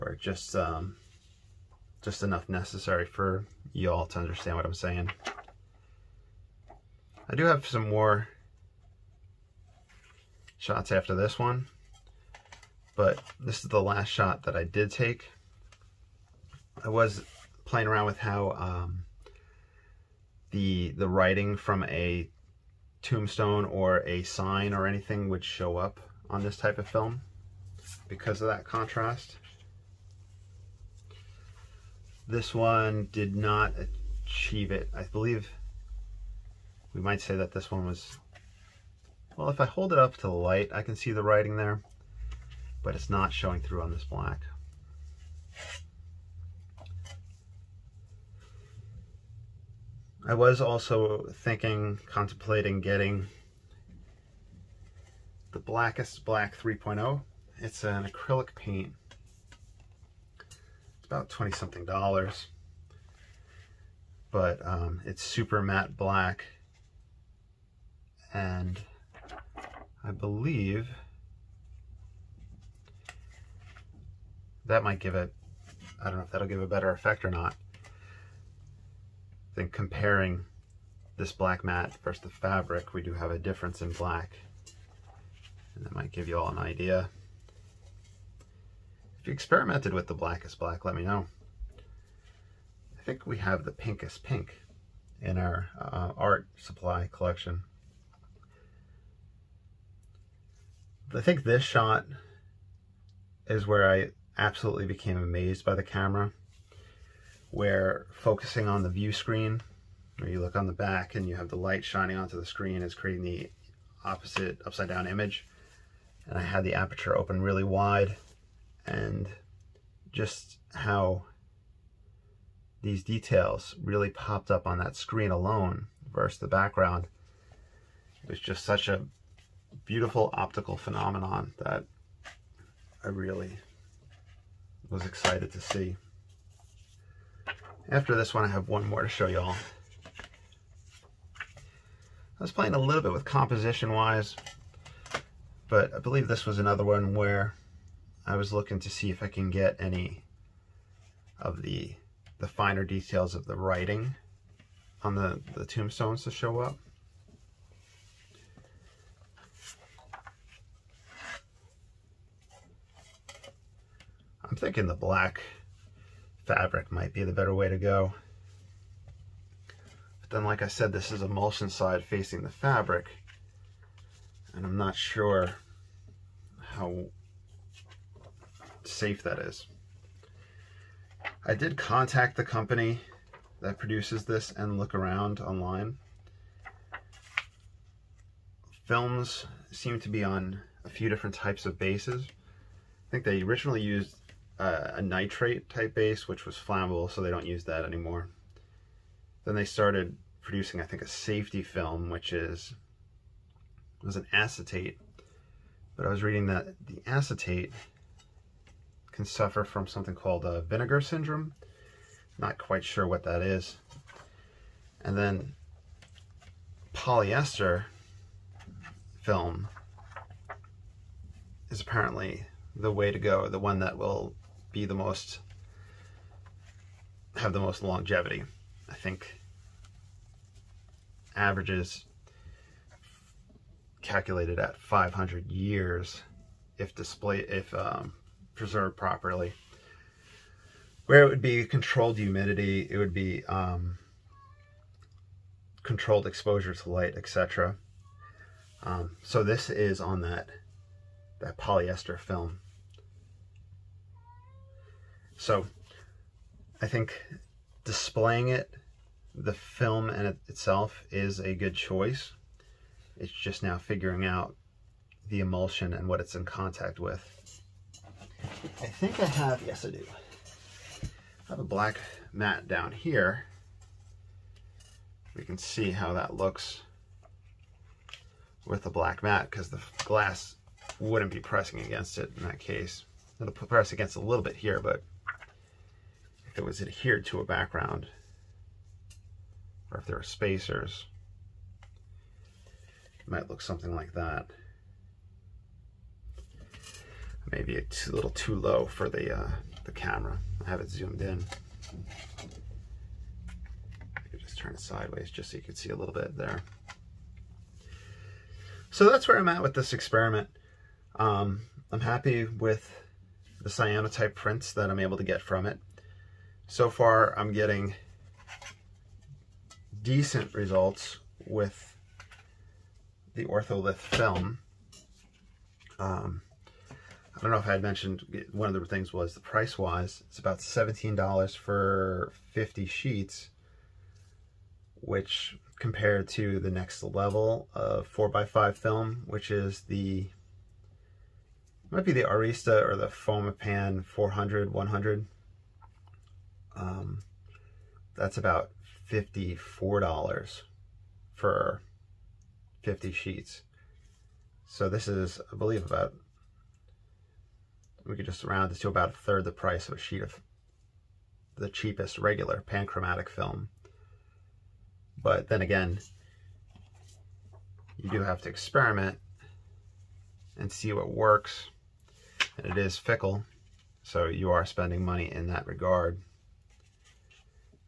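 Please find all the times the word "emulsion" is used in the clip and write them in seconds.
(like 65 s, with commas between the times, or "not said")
171 s, 265 s.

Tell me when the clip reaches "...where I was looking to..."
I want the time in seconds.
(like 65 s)
147 s.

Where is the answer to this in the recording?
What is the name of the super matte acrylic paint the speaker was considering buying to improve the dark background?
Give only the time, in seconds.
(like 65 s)
55 s.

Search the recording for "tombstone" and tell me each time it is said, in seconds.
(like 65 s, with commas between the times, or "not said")
23 s, 155 s.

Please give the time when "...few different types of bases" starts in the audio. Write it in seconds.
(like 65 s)
190 s.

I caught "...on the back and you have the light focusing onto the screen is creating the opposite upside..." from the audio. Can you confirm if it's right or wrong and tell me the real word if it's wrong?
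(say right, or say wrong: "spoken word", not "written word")
wrong: "shining", not "focusing".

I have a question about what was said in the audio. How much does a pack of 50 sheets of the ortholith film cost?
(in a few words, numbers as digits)
$17.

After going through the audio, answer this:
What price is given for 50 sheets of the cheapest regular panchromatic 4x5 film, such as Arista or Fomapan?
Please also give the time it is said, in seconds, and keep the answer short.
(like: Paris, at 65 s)
$54, at 349 s.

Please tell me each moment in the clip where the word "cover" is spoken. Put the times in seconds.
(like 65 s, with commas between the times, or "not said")
not said.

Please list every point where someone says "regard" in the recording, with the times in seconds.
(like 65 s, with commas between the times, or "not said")
375 s.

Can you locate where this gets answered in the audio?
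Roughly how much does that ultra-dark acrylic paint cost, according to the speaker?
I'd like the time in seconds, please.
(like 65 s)
61 s.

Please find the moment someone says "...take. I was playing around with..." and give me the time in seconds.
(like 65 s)
14 s.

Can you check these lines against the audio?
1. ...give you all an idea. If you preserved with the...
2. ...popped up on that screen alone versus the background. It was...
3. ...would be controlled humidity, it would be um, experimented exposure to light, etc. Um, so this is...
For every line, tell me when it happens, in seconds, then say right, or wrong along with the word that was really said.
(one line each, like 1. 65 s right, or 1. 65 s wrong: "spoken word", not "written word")
1. 86 s wrong: "experimented", not "preserved"
2. 124 s right
3. 241 s wrong: "controlled", not "experimented".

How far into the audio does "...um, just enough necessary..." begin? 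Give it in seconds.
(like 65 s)
0 s.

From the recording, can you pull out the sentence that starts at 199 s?
Then they started producing, I think, a safety film, which is was an acetate.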